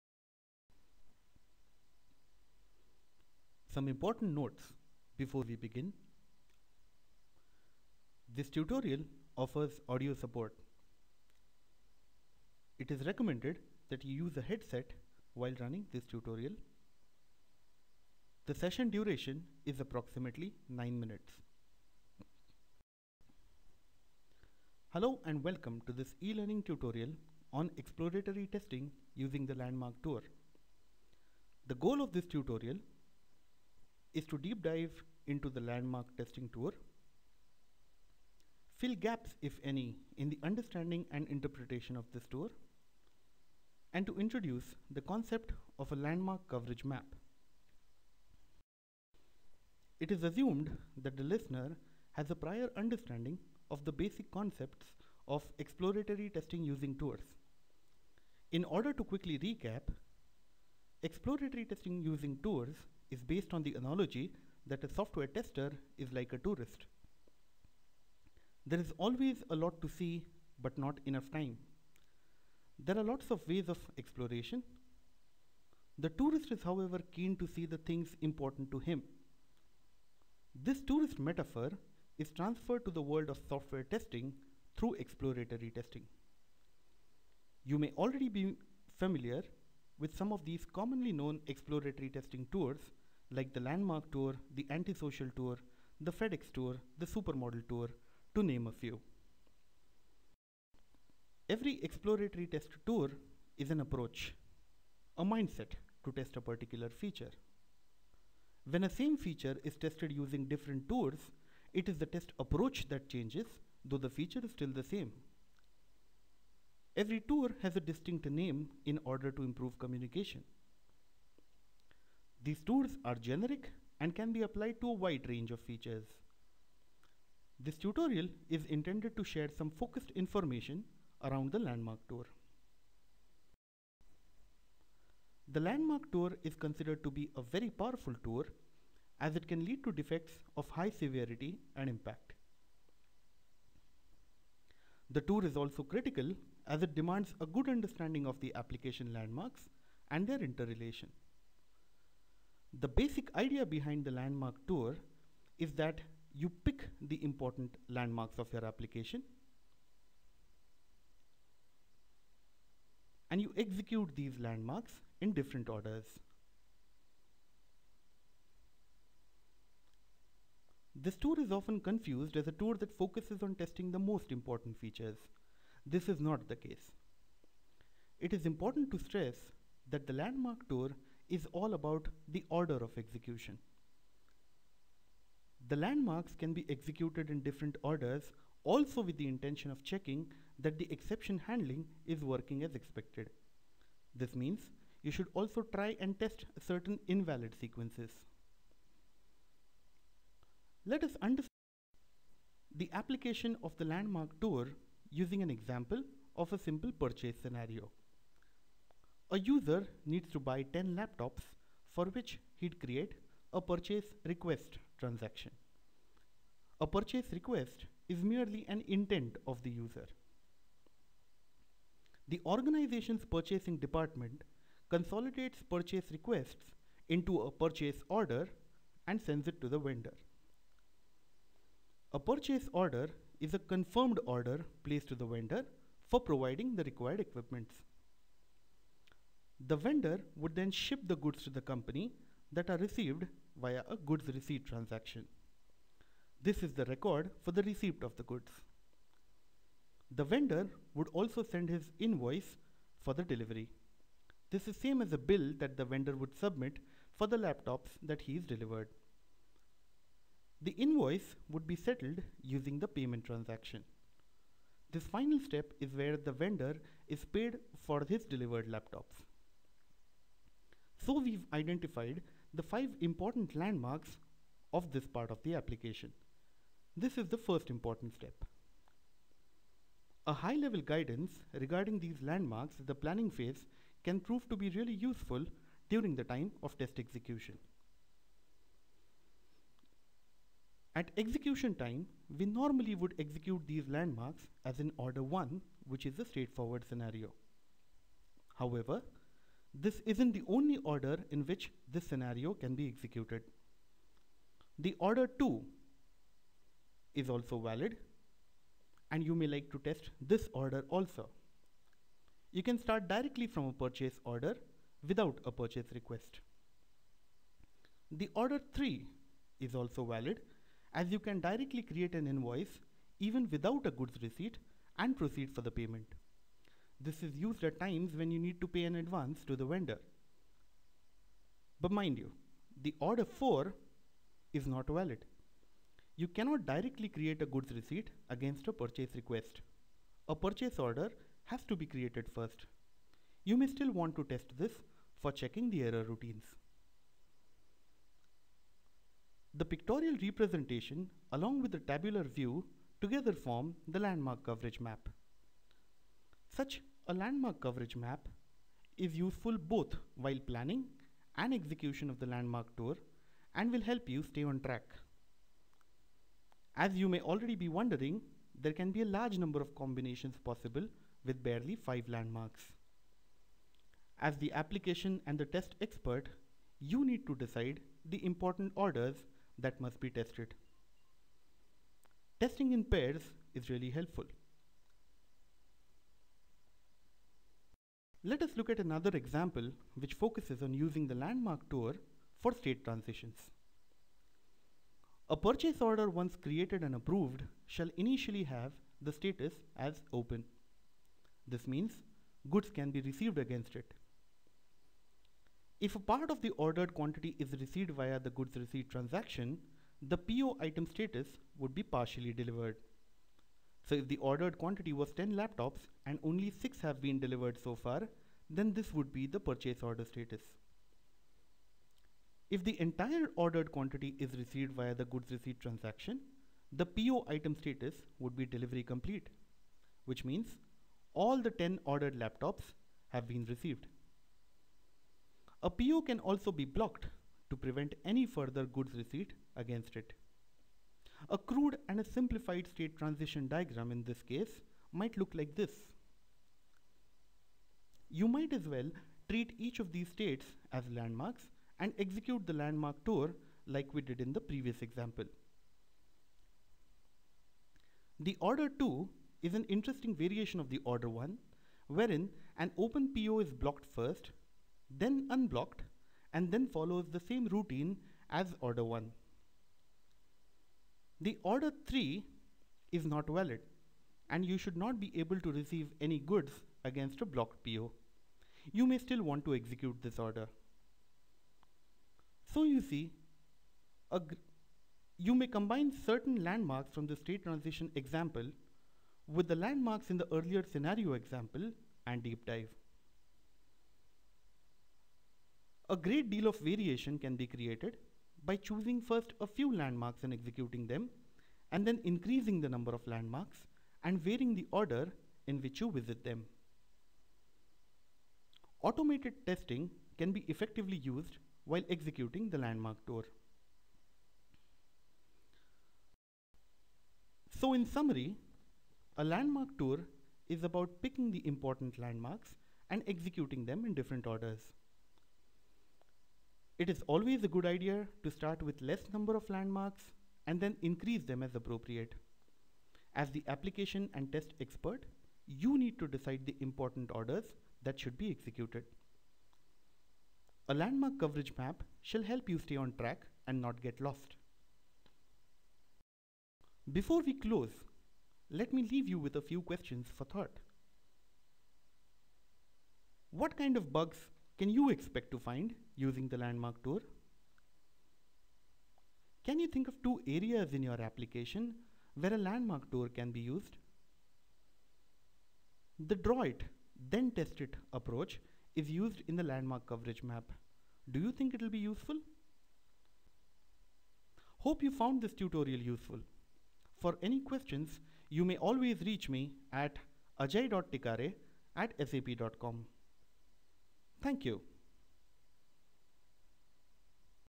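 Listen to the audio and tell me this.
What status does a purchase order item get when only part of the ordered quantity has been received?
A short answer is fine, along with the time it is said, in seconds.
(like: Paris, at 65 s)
partially delivered, at 411 s.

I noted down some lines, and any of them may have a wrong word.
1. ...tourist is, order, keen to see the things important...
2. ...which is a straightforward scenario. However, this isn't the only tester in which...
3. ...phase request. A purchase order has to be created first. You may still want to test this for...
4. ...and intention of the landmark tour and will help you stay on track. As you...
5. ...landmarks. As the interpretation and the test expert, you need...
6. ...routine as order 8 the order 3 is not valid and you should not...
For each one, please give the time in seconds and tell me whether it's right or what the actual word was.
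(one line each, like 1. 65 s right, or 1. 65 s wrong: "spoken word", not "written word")
1. 76 s wrong: "however", not "order"
2. 295 s wrong: "order", not "tester"
3. 338 s wrong: "purchase", not "phase"
4. 361 s wrong: "execution", not "intention"
5. 372 s wrong: "application", not "interpretation"
6. 467 s wrong: "1", not "8".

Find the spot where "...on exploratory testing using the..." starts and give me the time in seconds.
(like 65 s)
27 s.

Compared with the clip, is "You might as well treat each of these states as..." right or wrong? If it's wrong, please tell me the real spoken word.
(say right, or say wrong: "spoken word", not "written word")
right.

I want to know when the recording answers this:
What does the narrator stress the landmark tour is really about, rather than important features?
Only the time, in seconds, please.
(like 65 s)
182 s.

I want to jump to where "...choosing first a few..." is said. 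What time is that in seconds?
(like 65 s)
498 s.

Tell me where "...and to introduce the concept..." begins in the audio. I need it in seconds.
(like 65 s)
43 s.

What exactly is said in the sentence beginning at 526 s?
It is always a good idea to start with less number of landmarks and then increase them as appropriate.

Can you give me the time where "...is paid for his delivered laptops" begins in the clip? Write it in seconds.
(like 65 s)
267 s.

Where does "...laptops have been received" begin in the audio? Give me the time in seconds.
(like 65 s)
432 s.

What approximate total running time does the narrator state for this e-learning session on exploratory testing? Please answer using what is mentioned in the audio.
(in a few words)
9 minutes.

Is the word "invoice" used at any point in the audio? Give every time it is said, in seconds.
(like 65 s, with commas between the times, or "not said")
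251 s, 260 s, 322 s.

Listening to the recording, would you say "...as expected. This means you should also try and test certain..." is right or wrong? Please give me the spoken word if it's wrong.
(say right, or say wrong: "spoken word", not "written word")
right.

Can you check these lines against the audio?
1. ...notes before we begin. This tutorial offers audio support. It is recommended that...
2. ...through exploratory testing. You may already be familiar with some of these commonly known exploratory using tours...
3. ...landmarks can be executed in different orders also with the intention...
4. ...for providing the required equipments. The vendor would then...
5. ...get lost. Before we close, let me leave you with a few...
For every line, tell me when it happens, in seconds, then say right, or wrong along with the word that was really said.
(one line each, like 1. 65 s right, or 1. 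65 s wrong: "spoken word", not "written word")
1. 4 s right
2. 84 s wrong: "testing", not "using"
3. 185 s right
4. 236 s right
5. 543 s right.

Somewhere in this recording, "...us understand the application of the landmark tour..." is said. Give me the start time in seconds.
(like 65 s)
201 s.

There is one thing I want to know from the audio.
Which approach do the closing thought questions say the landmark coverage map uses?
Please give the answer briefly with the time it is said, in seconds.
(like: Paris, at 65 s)
draw it, then test it, at 566 s.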